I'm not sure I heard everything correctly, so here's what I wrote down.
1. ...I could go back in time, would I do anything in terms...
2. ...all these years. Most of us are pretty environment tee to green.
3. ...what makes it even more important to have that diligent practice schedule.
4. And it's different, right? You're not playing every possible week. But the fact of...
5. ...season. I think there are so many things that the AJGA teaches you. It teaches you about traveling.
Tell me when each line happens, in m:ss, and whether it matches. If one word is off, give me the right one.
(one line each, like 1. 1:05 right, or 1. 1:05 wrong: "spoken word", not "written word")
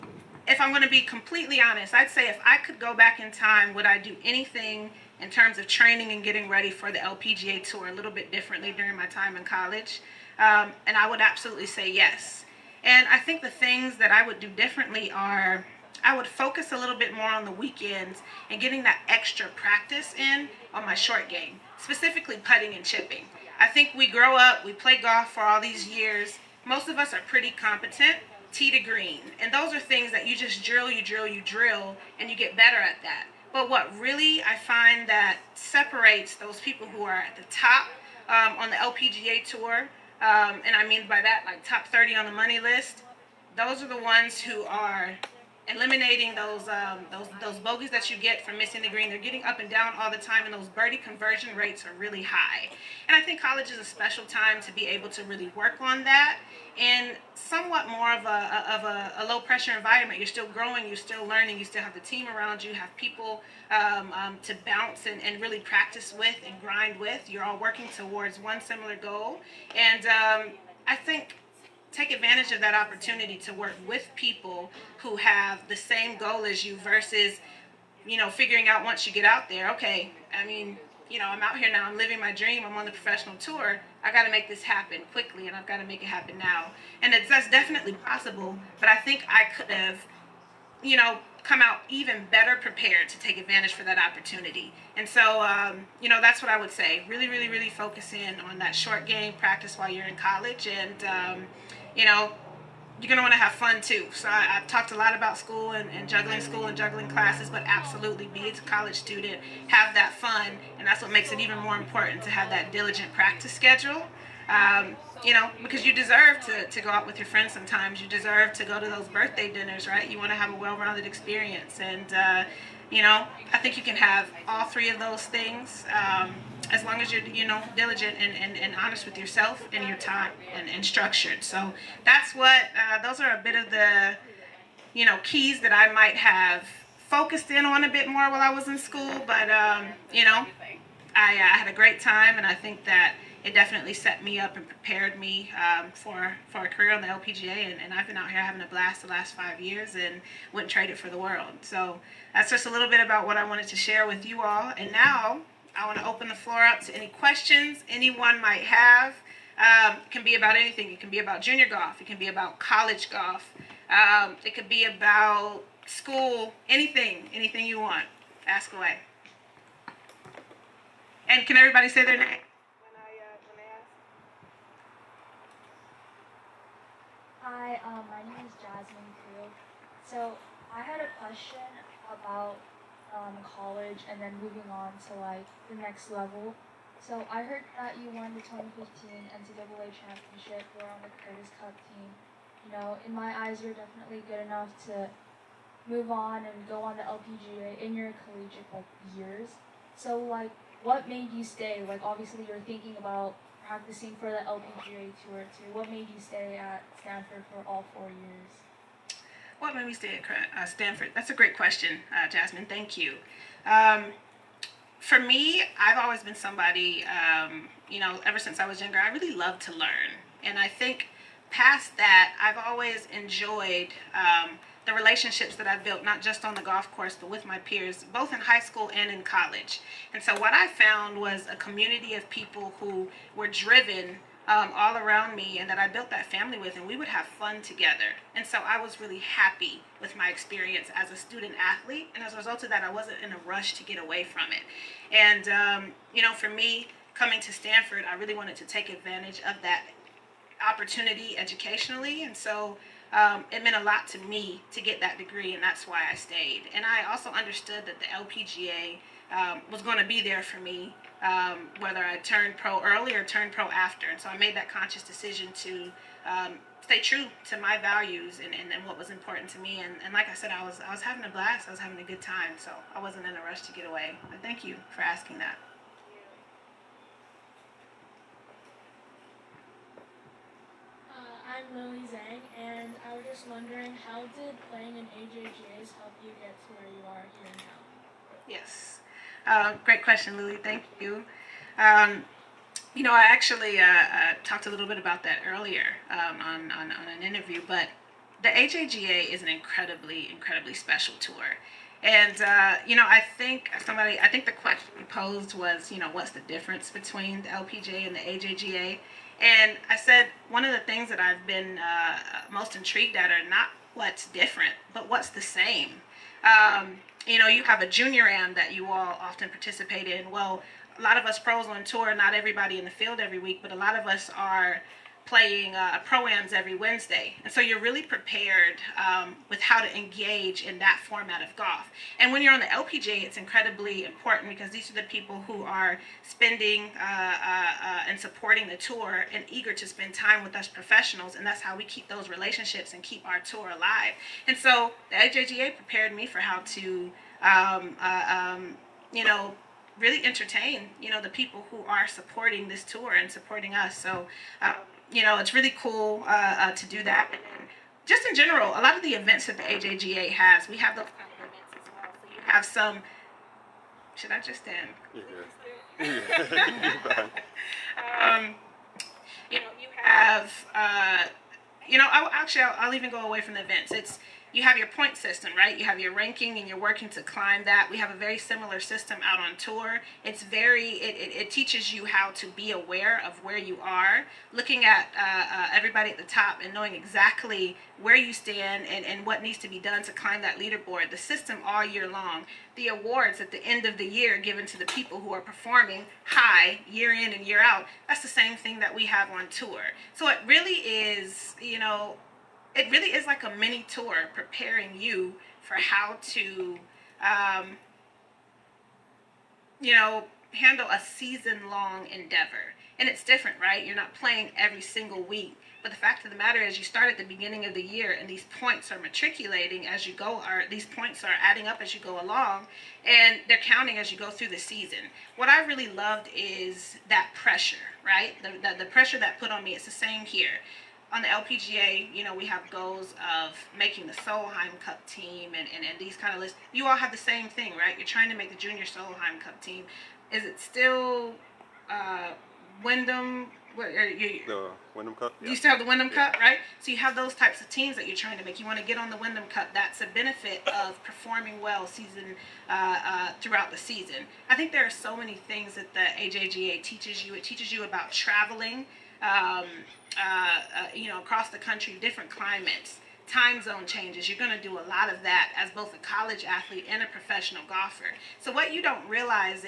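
1. 0:02 right
2. 0:25 wrong: "competent", not "environment"
3. 1:51 right
4. 6:52 wrong: "single", not "possible"
5. 7:33 right.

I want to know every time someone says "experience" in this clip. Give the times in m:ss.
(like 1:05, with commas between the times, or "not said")
2:01, 4:00.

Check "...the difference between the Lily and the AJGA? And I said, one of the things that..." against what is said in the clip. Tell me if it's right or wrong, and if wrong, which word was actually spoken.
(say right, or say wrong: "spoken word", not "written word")
wrong: "LPGA", not "Lily".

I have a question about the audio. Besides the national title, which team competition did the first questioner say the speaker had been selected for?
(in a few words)
Curtis Cup.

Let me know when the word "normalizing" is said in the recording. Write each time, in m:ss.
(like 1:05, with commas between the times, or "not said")
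not said.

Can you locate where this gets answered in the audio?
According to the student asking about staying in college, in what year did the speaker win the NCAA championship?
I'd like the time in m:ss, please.
3:08.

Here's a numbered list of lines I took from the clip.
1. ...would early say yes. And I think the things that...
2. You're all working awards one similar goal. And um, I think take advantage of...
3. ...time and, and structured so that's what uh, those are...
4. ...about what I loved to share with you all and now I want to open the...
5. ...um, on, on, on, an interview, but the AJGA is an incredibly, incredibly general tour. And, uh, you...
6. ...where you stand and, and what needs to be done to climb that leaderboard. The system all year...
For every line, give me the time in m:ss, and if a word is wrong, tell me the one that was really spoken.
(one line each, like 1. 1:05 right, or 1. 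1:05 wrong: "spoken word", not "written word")
1. 0:11 wrong: "absolutely", not "early"
2. 1:07 wrong: "towards", not "awards"
3. 2:09 right
4. 2:32 wrong: "wanted", not "loved"
5. 4:56 wrong: "special", not "general"
6. 6:28 right.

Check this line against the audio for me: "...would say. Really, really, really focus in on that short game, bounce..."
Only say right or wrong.
wrong.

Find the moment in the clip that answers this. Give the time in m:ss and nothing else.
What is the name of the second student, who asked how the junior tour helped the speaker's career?
4:41.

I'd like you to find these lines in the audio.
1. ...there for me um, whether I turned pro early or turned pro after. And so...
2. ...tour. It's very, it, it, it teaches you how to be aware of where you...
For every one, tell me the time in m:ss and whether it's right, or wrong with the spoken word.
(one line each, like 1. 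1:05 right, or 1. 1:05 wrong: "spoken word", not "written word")
1. 4:20 right
2. 6:19 right.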